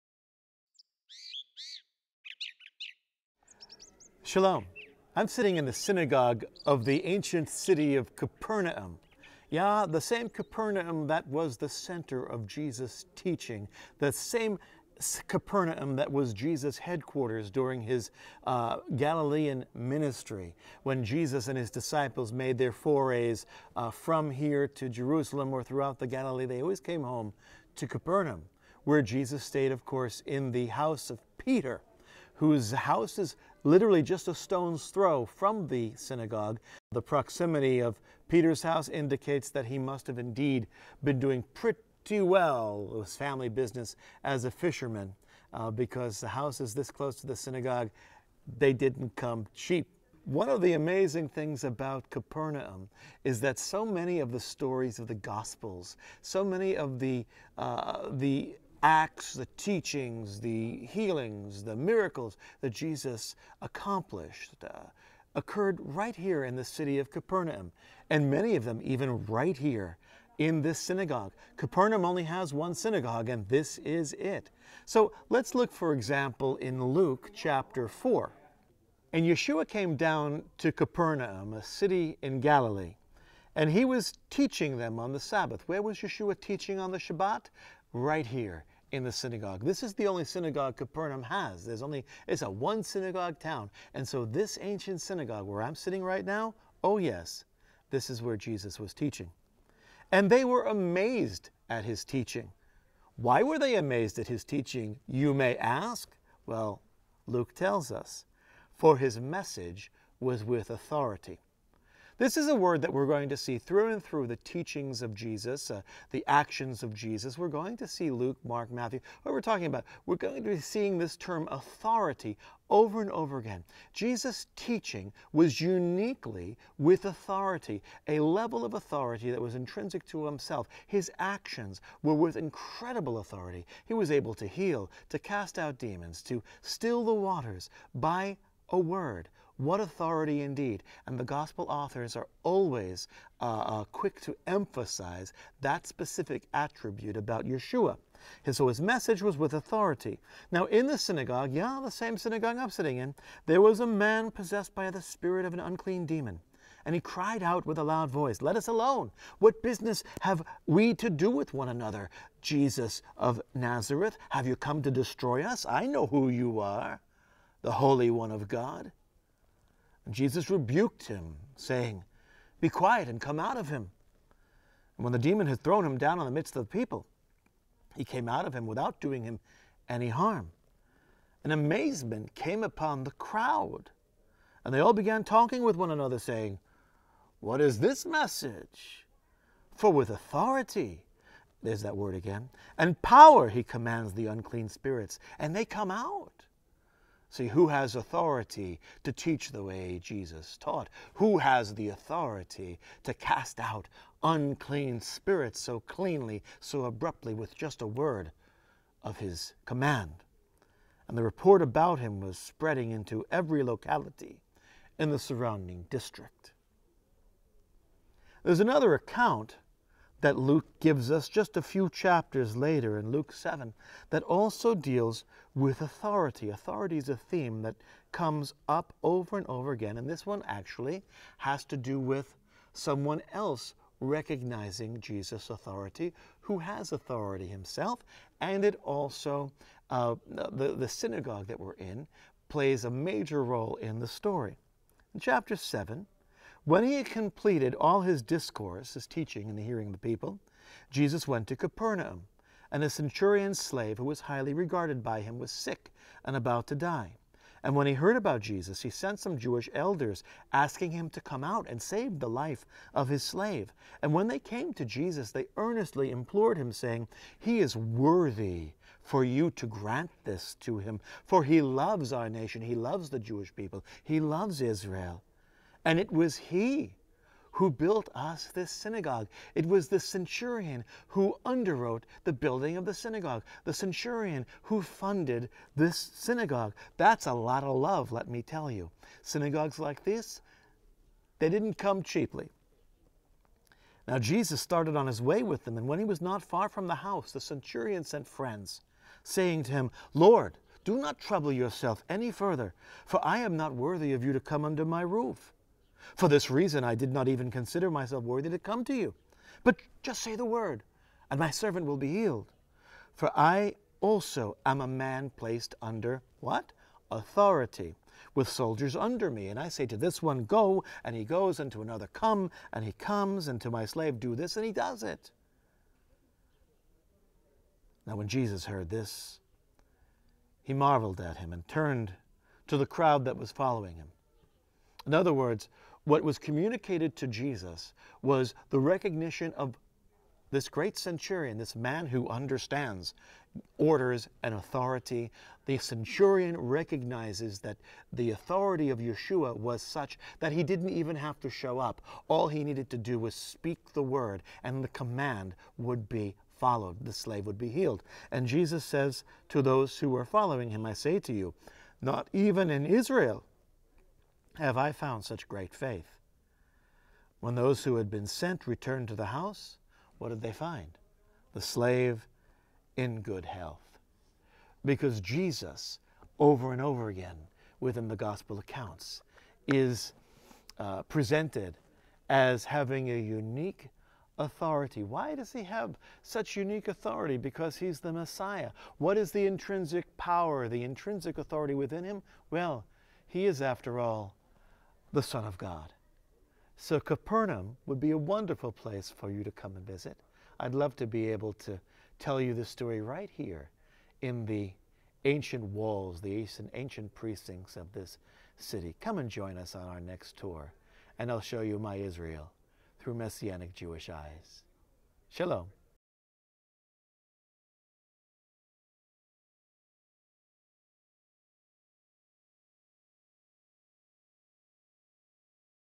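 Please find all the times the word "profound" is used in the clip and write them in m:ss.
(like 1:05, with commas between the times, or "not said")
not said.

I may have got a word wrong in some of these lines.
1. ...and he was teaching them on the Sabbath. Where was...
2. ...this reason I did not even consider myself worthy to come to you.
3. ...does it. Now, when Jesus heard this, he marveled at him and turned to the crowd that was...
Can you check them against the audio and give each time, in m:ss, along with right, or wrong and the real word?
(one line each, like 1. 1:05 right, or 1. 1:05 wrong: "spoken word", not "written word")
1. 1:23 right
2. 5:06 right
3. 5:24 right.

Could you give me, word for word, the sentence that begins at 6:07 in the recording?
When those who had been sent returned to the house, what did they find?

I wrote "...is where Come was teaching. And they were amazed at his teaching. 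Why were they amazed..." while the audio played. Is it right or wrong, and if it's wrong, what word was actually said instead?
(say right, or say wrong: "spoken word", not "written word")
wrong: "Jesus", not "Come".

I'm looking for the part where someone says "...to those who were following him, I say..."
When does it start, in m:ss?
5:59.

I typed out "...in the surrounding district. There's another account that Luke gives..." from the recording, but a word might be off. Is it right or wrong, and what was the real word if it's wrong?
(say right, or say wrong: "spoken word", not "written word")
right.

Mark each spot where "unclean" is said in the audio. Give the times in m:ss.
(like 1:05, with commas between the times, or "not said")
2:35, 3:14, 3:24.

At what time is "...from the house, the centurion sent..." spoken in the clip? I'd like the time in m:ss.
4:56.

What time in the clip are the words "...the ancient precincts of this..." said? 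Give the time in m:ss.
6:46.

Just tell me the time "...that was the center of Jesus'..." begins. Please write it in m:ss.
0:11.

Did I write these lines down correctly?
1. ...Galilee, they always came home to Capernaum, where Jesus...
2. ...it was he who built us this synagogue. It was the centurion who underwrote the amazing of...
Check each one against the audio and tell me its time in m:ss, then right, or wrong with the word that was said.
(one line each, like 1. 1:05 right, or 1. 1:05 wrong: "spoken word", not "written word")
1. 0:26 right
2. 4:35 wrong: "building", not "amazing".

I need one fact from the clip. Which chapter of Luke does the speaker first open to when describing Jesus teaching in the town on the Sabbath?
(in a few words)
Chapter 4.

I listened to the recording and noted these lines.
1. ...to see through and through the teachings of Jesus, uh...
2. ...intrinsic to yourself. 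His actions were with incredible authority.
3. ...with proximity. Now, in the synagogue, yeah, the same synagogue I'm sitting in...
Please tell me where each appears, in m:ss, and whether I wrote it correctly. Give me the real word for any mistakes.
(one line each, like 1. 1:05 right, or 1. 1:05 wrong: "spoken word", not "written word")
1. 1:53 right
2. 2:09 wrong: "himself", not "yourself"
3. 2:29 wrong: "authority", not "proximity".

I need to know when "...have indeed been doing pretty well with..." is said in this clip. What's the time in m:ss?
0:40.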